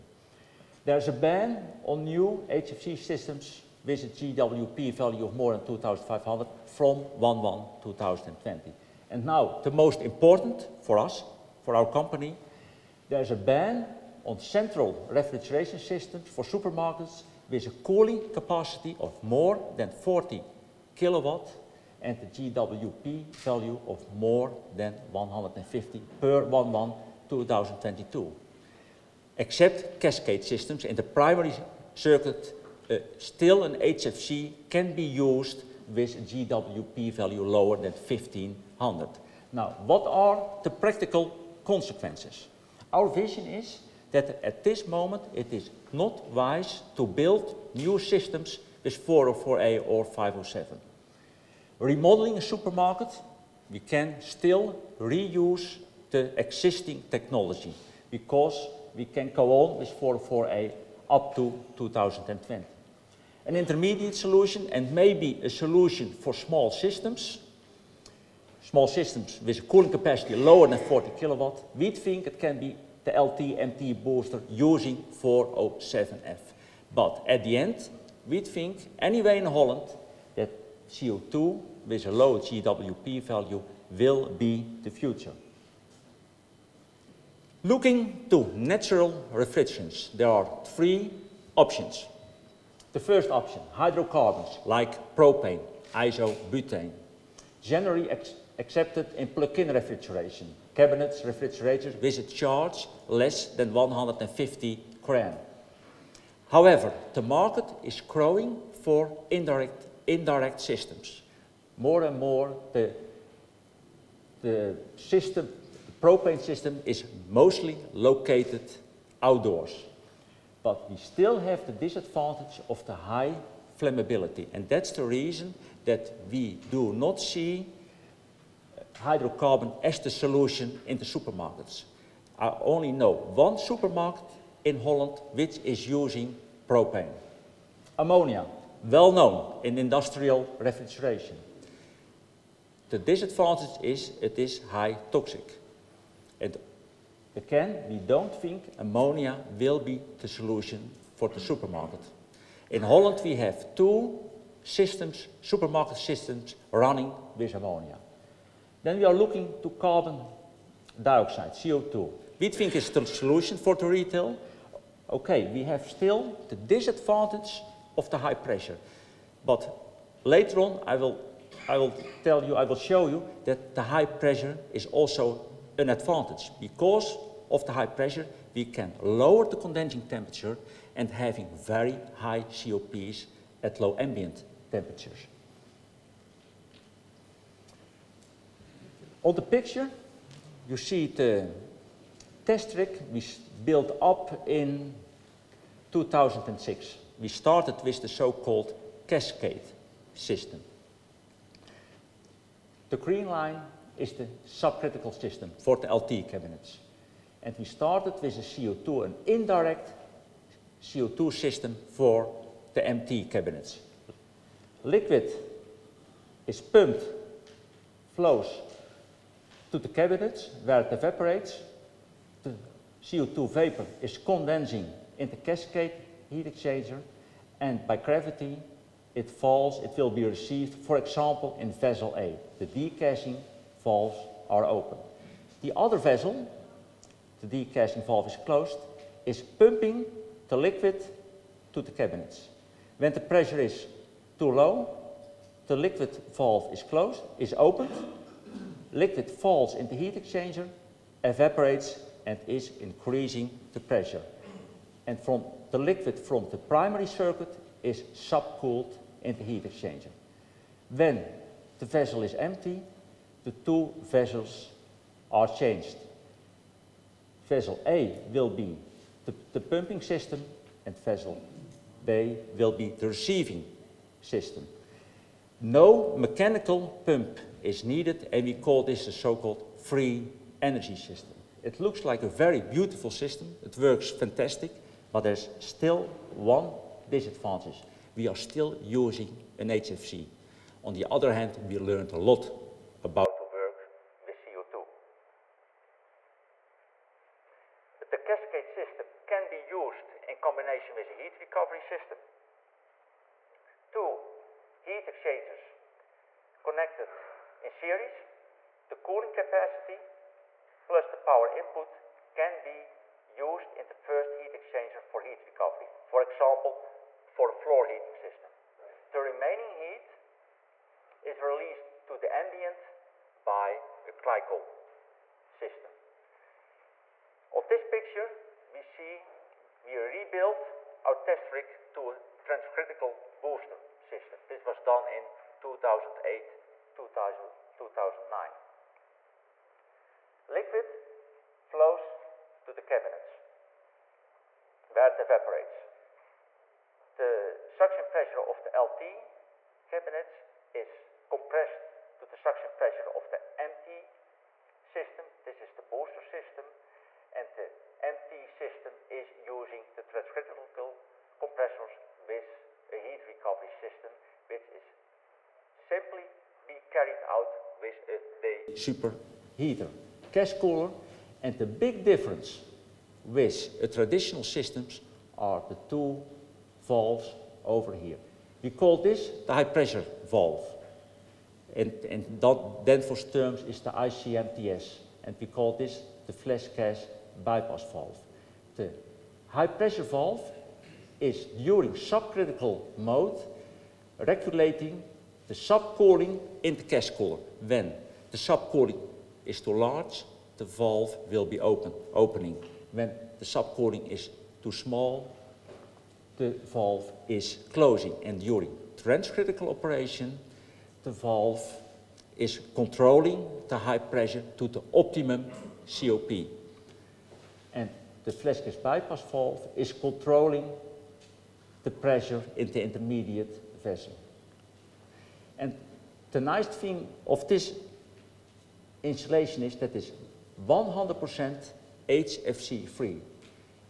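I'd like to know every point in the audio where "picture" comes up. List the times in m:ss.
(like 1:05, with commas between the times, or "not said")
3:09, 5:27.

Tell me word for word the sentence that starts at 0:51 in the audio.
Remodeling a supermarket, we can still reuse the existing technology because we can go on with 404A up to 2020.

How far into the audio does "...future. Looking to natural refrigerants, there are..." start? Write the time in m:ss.
1:24.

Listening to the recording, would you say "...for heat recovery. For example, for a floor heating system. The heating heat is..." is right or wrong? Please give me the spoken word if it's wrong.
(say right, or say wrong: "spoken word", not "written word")
wrong: "remaining", not "heating".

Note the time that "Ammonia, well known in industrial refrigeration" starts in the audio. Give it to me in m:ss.
2:17.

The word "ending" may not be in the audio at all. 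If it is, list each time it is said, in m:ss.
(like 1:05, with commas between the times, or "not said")
not said.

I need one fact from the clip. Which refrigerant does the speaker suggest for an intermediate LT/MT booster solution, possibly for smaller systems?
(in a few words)
407F.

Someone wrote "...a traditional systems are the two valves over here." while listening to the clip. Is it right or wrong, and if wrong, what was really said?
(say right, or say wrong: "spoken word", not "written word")
right.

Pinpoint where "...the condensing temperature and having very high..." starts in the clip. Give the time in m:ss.
2:59.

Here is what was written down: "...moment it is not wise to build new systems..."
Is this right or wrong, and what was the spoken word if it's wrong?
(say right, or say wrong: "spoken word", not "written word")
right.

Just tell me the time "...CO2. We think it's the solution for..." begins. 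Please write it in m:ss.
2:41.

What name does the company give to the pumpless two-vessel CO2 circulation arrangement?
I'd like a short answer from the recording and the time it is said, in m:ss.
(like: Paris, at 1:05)
free energy system, at 4:39.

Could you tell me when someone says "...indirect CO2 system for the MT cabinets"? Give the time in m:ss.
3:29.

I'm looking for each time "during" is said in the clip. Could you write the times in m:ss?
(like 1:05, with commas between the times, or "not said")
6:31, 6:48.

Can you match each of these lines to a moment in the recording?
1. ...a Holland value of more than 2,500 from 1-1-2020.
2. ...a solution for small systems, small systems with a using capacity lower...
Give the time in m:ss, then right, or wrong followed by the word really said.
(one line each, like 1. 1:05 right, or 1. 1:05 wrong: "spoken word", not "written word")
1. 0:04 wrong: "GWP", not "Holland"
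2. 1:05 wrong: "cooling", not "using".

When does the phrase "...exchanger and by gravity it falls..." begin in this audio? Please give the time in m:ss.
3:46.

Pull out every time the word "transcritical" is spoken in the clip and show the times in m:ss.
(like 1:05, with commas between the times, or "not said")
5:32, 6:00, 6:48.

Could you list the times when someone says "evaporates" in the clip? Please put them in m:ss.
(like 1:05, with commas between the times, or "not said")
3:40, 4:11, 5:45.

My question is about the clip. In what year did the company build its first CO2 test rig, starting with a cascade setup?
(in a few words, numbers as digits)
2006.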